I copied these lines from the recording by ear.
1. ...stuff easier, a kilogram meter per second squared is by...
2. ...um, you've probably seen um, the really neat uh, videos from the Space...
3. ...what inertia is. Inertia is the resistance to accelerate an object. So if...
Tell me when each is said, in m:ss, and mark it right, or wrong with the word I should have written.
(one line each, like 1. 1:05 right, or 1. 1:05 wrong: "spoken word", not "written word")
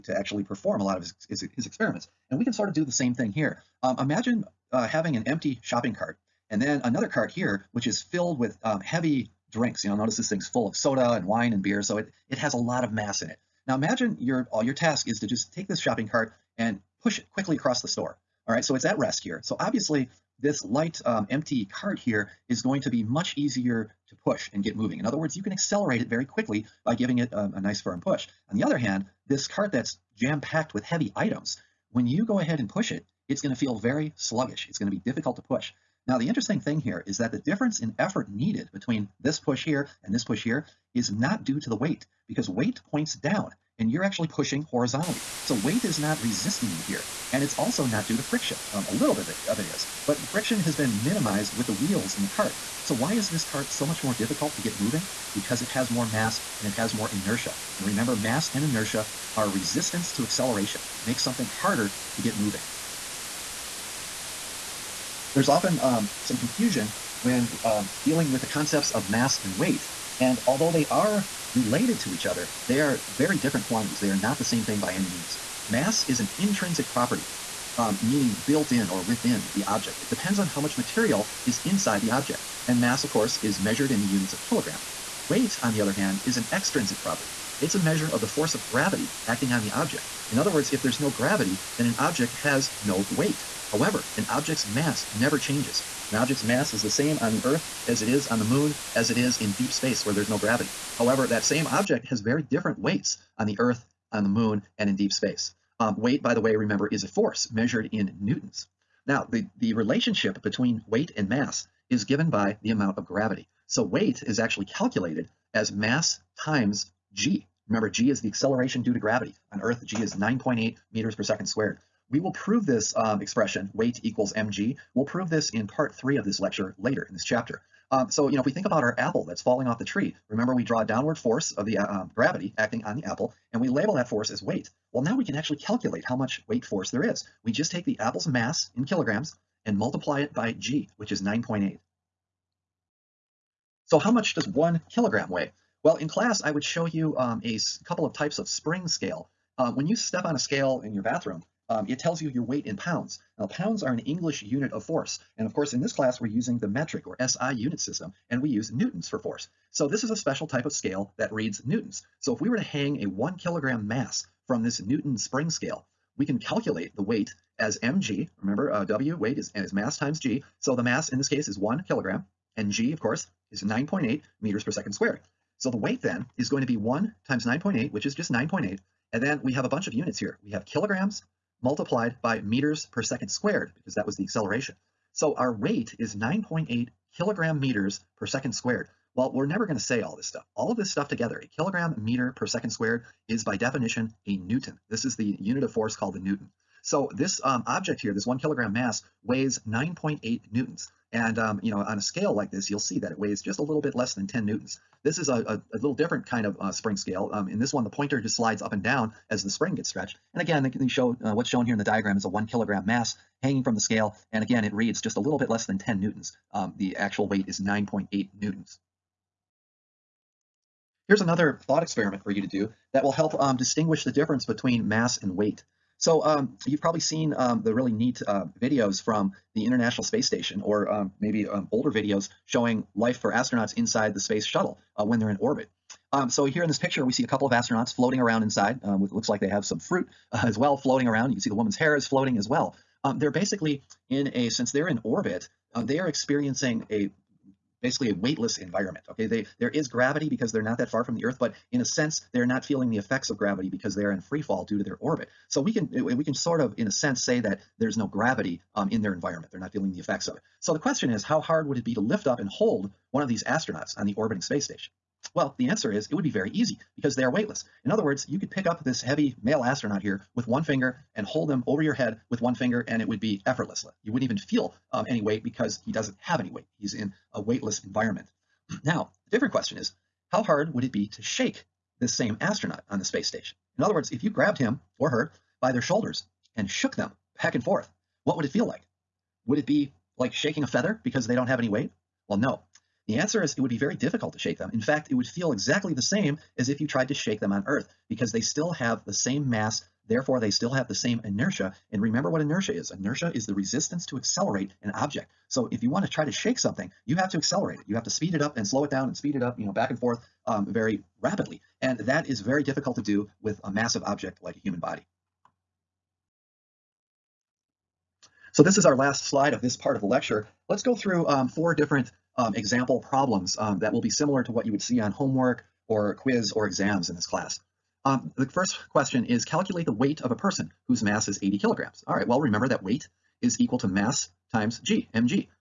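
1. 3:10 wrong: "together", not "easier"
2. 3:46 wrong: "International", not "Space"
3. 5:02 right.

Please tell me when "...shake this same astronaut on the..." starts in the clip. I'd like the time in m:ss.
4:41.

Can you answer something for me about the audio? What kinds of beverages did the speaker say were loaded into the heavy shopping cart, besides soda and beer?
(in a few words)
wine.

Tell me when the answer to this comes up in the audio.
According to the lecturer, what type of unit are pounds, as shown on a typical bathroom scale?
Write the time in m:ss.
2:33.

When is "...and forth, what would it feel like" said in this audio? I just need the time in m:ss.
4:47.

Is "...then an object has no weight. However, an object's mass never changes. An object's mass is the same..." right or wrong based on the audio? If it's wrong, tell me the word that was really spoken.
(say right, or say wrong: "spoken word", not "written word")
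right.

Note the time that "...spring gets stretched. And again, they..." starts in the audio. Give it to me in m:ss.
3:29.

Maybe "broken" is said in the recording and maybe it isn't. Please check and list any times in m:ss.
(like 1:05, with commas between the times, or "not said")
not said.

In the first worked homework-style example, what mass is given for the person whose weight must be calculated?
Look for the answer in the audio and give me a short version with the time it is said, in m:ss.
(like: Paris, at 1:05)
80 kilograms, at 5:31.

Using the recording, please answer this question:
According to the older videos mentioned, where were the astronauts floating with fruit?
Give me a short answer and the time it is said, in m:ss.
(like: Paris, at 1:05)
space shuttle, at 3:54.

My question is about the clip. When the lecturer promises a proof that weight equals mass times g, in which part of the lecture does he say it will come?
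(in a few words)
part three.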